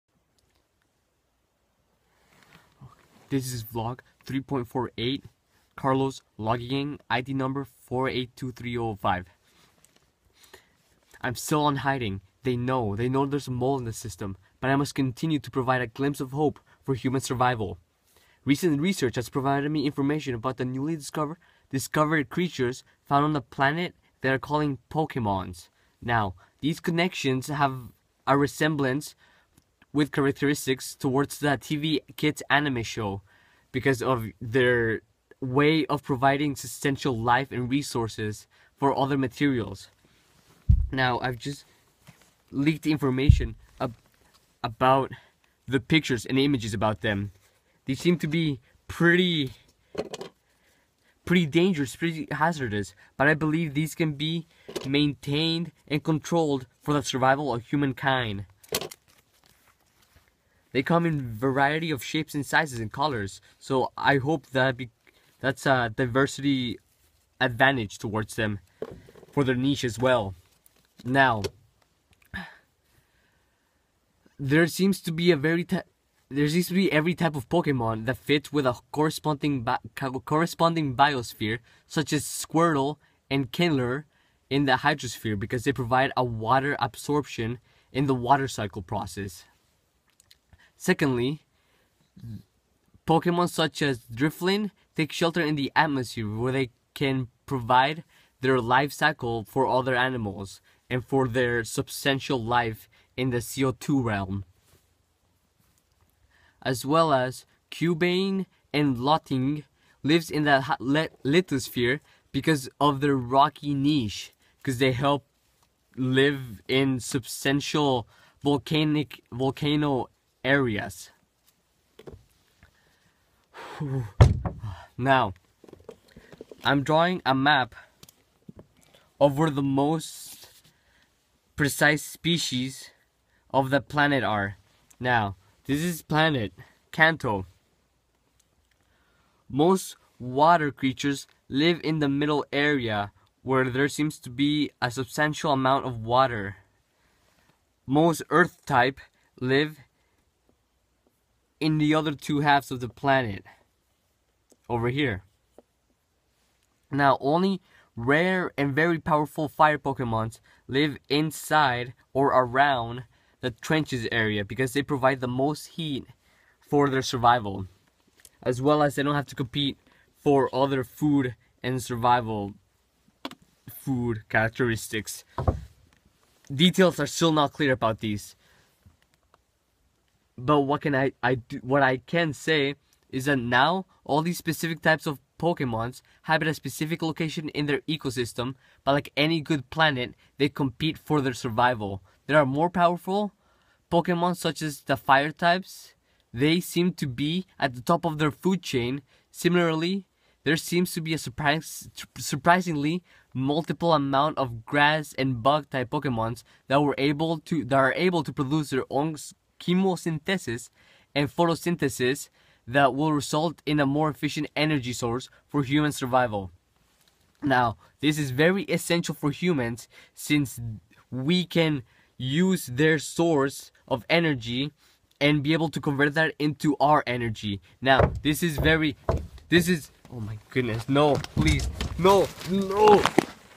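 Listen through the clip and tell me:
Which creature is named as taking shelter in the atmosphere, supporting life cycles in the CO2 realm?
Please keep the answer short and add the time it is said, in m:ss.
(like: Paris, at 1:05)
Drifloon, at 1:34.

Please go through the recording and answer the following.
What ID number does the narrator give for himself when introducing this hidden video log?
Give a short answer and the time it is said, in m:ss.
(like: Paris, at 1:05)
482305, at 0:07.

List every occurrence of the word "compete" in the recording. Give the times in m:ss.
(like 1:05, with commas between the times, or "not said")
2:49, 3:10.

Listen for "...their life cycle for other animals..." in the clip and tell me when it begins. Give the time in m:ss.
1:38.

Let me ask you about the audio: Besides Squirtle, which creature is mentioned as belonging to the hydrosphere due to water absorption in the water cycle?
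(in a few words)
Kingler.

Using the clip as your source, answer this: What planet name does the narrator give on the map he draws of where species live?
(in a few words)
Kanto.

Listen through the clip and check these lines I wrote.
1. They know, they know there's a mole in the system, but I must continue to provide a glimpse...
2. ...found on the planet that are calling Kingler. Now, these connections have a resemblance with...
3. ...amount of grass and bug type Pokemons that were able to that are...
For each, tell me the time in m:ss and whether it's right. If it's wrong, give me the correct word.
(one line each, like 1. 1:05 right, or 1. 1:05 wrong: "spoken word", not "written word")
1. 0:12 right
2. 0:23 wrong: "Pokemons", not "Kingler"
3. 3:23 right.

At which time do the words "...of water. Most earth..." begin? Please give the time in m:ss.
2:25.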